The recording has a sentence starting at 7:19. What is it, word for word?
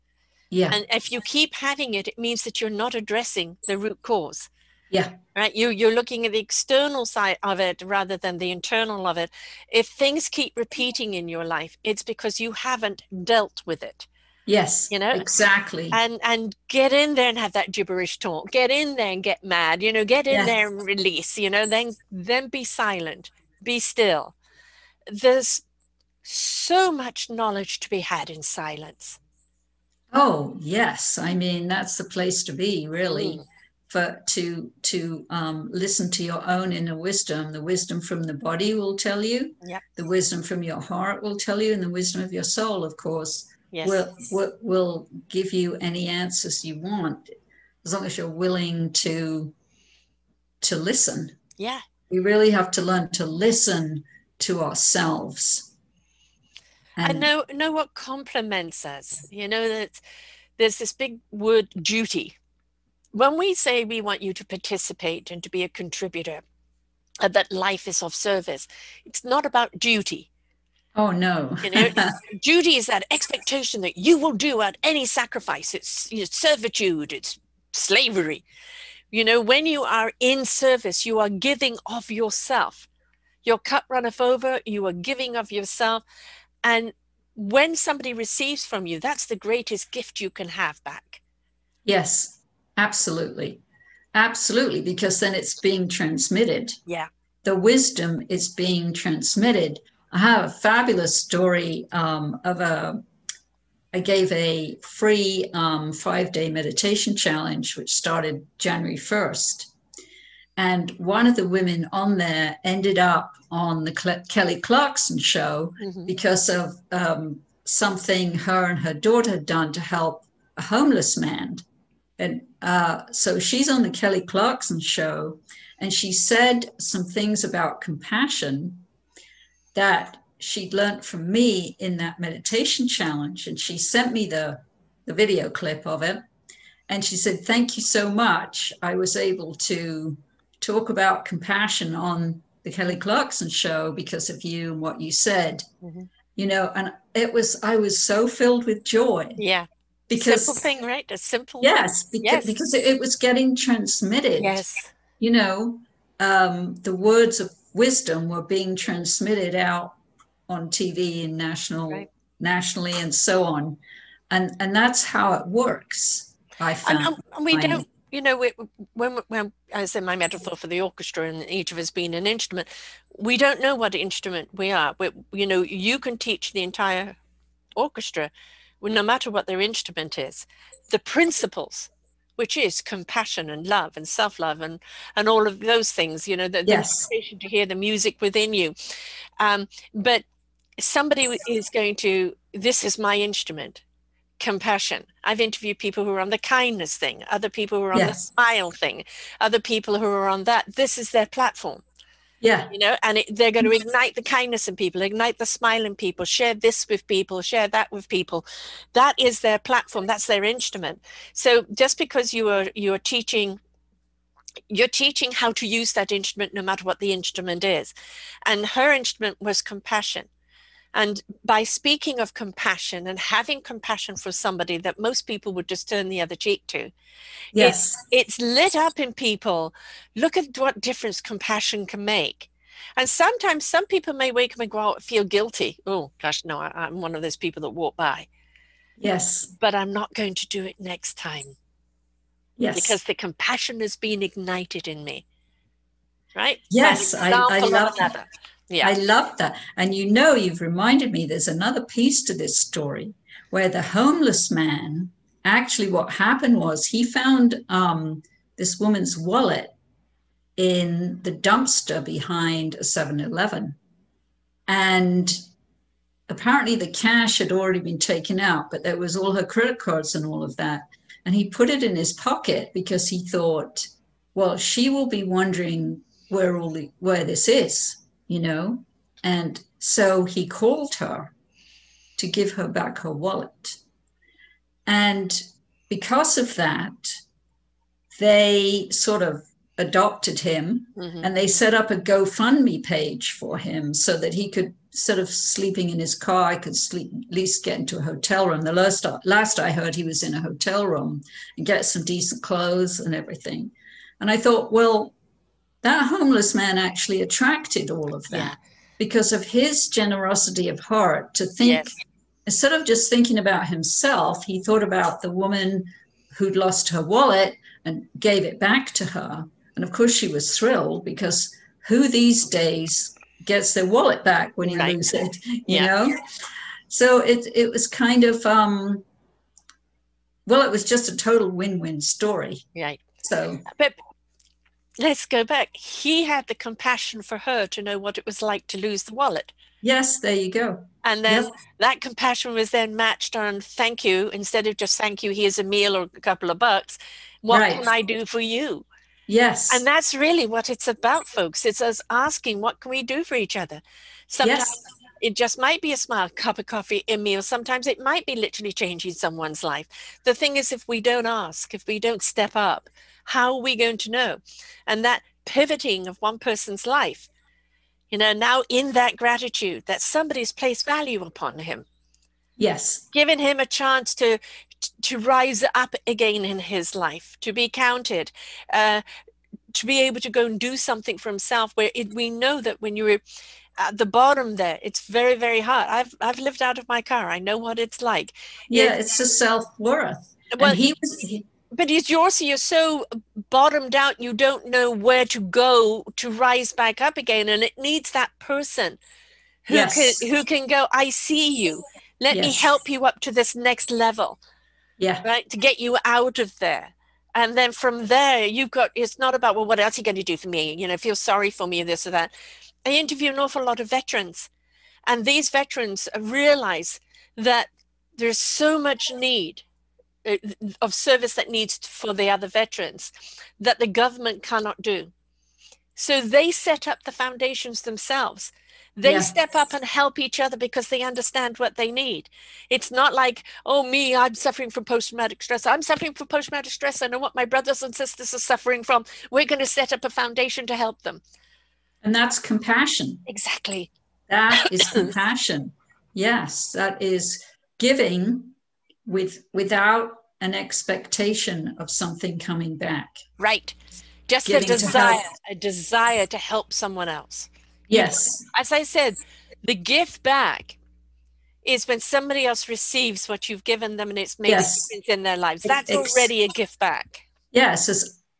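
We're going to set up a foundation to help them.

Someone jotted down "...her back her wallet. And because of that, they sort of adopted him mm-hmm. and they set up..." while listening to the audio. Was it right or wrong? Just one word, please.
right.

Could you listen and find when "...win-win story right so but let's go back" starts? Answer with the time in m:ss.
5:31.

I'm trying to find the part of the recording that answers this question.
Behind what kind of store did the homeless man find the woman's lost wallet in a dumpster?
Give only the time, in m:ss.
4:22.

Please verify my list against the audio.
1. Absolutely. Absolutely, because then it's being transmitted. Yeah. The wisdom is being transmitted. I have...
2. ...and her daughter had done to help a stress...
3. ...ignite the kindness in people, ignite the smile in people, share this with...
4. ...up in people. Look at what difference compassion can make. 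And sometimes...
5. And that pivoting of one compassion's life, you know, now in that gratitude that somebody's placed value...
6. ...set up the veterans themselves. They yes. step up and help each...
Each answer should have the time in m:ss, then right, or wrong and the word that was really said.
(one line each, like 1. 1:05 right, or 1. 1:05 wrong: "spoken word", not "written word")
1. 1:32 right
2. 1:58 wrong: "homeless", not "stress"
3. 3:23 right
4. 3:48 right
5. 6:04 wrong: "person", not "compassion"
6. 7:06 wrong: "foundations", not "veterans".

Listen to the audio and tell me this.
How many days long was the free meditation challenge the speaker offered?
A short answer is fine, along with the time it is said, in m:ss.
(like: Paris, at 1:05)
5, at 1:45.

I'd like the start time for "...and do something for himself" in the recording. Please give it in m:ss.
6:20.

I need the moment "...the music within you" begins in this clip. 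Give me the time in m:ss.
3:07.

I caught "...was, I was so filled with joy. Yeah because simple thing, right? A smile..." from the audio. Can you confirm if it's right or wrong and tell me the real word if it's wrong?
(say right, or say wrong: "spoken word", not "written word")
wrong: "simple", not "smile".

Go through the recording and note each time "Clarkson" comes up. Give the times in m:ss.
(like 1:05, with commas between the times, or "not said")
1:54, 2:04, 2:22.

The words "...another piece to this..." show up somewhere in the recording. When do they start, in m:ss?
4:11.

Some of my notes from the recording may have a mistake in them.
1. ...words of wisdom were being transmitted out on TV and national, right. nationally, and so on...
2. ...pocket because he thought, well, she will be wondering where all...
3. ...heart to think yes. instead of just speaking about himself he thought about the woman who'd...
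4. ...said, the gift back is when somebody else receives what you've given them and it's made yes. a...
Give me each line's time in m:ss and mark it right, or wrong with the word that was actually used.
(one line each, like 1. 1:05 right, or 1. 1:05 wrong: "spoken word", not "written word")
1. 2:36 right
2. 4:32 right
3. 5:10 wrong: "thinking", not "speaking"
4. 7:38 right.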